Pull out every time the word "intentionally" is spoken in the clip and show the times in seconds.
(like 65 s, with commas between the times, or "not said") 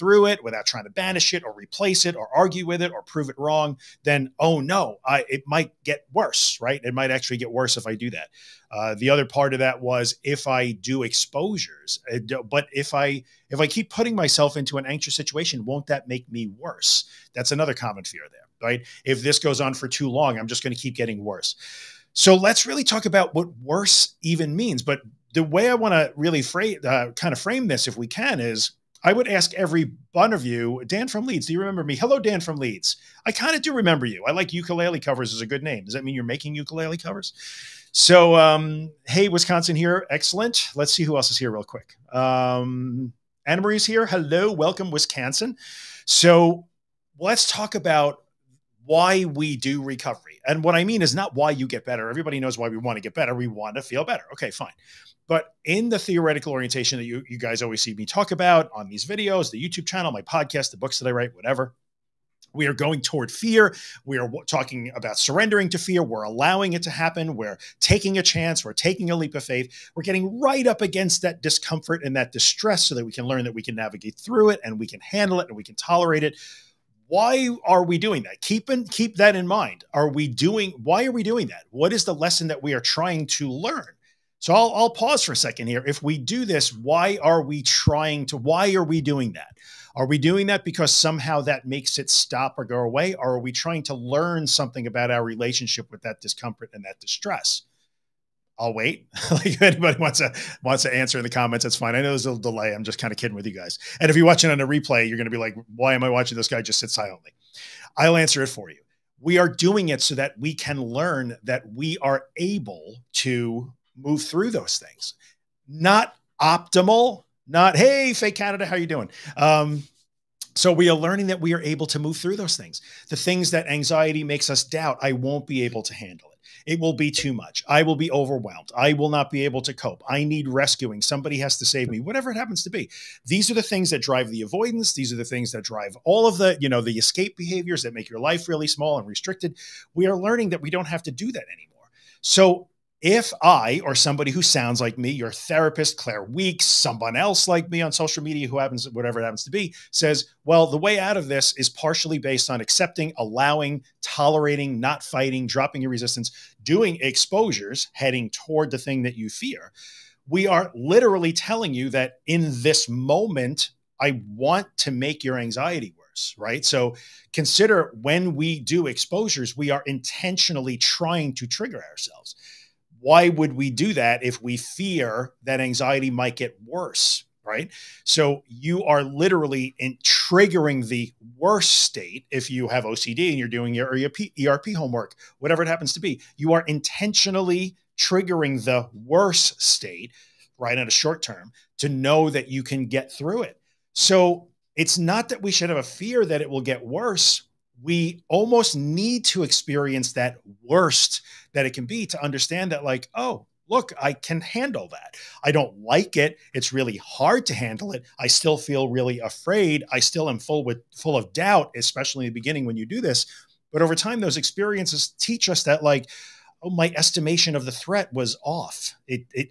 169 s, 186 s.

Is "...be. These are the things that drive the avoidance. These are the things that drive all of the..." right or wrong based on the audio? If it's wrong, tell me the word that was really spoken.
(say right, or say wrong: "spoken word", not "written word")
right.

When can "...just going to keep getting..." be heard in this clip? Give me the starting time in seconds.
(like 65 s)
20 s.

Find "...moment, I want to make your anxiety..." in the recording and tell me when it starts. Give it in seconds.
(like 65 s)
162 s.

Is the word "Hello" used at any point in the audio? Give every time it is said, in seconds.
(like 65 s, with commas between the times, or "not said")
31 s, 44 s.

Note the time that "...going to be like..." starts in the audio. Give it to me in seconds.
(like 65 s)
105 s.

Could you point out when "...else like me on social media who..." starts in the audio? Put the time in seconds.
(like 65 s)
147 s.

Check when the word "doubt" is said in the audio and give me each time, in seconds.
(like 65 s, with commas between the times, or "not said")
124 s, 211 s.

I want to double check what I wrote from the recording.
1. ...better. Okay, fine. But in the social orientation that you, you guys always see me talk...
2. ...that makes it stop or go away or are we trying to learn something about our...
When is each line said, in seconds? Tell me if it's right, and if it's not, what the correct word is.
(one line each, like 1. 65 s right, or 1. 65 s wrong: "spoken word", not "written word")
1. 54 s wrong: "theoretical", not "social"
2. 91 s right.